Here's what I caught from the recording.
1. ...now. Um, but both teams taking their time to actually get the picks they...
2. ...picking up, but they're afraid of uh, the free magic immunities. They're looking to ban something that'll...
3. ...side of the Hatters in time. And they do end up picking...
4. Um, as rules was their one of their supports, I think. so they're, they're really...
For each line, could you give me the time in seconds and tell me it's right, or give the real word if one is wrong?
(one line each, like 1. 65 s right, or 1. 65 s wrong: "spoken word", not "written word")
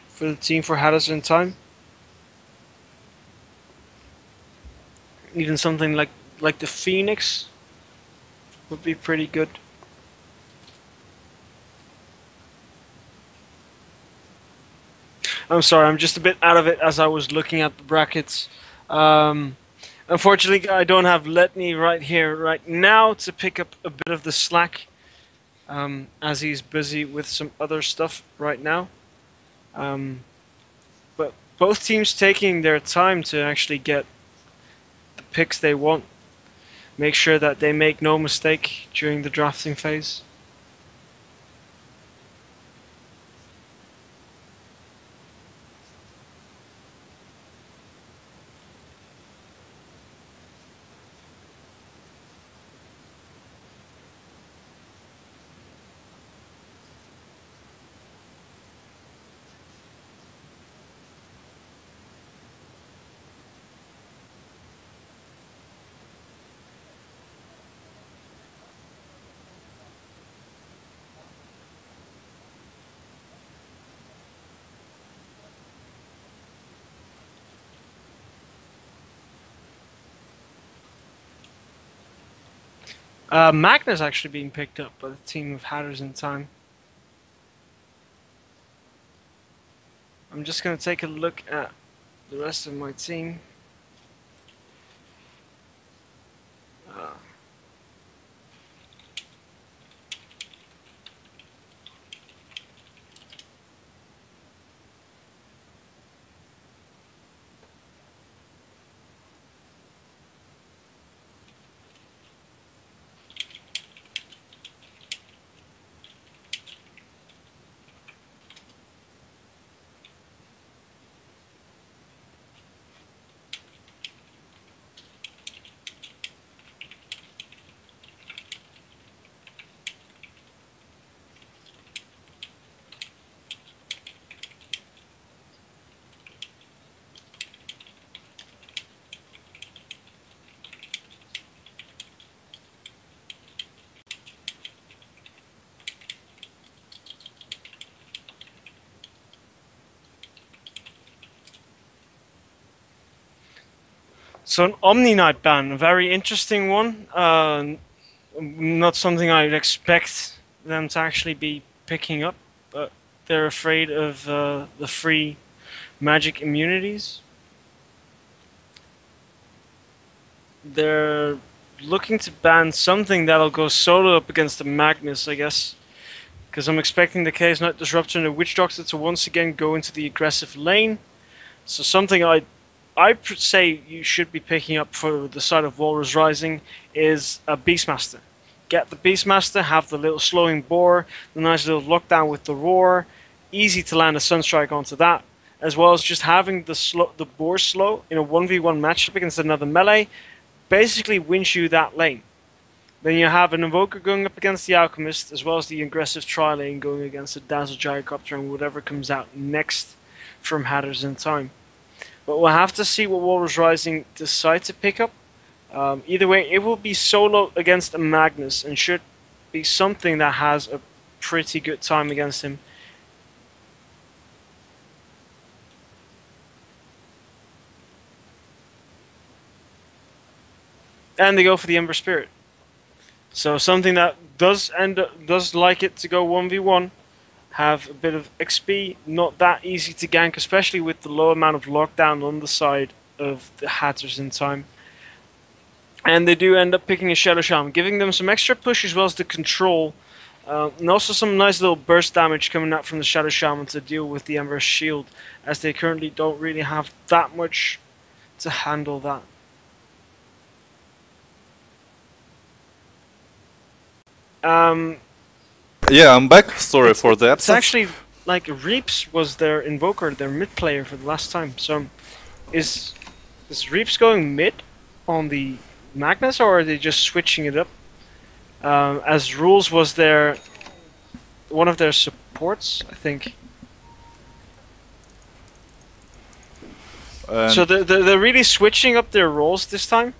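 1. 28 s right
2. 161 s right
3. 242 s right
4. 278 s right.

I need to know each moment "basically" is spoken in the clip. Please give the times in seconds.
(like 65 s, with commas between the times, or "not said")
200 s.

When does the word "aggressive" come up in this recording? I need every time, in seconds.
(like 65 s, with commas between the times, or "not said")
180 s, 205 s.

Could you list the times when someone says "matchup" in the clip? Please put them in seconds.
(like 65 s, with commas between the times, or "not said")
198 s.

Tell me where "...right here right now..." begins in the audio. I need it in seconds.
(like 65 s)
21 s.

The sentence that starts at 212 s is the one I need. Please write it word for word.
But we'll have to see what Walrus Rising decide to pick up.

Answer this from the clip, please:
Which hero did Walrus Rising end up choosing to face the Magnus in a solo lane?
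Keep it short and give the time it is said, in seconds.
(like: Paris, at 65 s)
Ember Spirit, at 231 s.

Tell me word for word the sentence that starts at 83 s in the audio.
Uh, Magna's actually being picked up by the team of Hatters in time.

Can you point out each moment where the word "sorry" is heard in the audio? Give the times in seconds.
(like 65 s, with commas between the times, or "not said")
15 s, 266 s.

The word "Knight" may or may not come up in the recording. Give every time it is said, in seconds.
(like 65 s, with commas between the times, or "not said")
155 s, 177 s.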